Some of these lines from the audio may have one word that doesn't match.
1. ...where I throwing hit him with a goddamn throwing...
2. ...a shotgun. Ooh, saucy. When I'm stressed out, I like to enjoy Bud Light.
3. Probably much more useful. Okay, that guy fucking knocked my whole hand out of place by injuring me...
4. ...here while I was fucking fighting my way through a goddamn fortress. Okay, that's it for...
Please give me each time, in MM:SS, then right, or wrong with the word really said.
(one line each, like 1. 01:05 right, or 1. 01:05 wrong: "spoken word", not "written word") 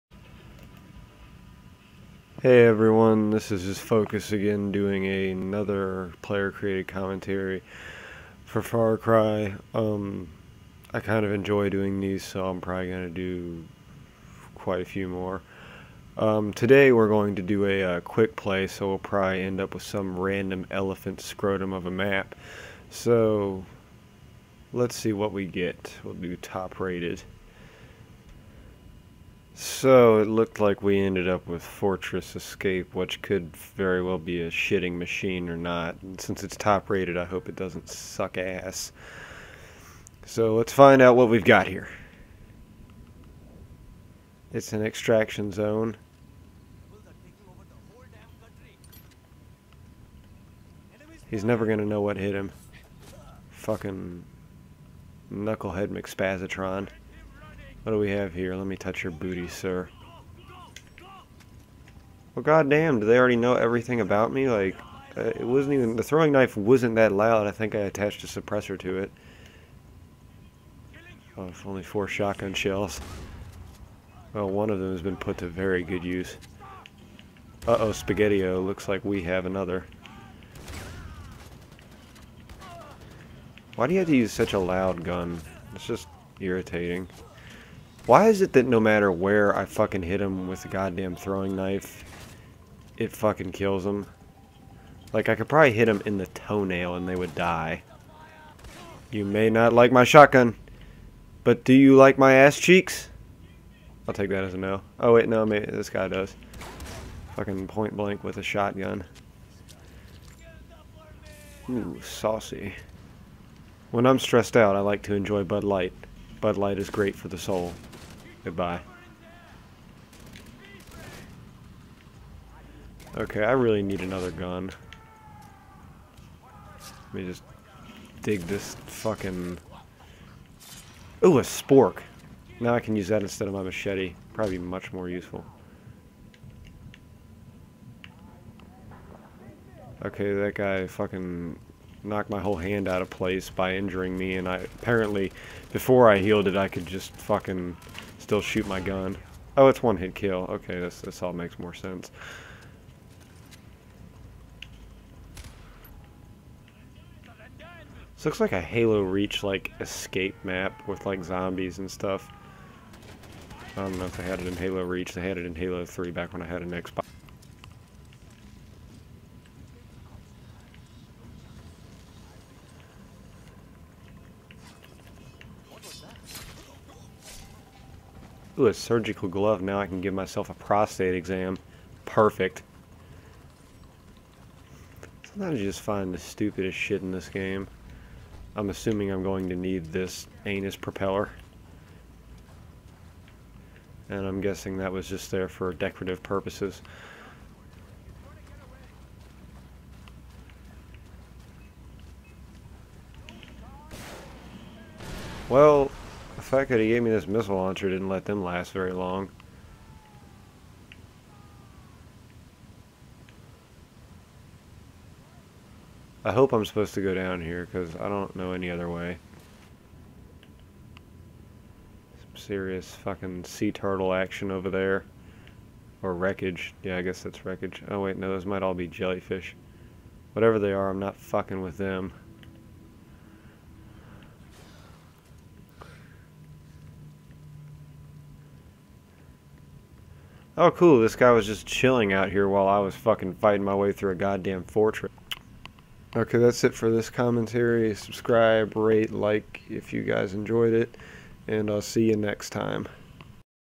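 1. 01:29 wrong: "fucking", not "throwing"
2. 01:48 right
3. 02:14 right
4. 04:02 right.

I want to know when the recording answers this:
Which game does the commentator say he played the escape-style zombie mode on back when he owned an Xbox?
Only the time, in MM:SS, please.
02:45.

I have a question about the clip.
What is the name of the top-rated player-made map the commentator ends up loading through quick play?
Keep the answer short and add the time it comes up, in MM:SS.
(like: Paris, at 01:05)
Fortress Escape, at 00:31.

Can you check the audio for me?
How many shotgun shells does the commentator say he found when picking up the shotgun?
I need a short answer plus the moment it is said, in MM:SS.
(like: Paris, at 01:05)
4, at 01:11.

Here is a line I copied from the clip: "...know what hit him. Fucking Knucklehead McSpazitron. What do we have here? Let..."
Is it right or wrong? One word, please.
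right.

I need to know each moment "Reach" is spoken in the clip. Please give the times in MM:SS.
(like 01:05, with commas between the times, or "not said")
02:39, 02:44.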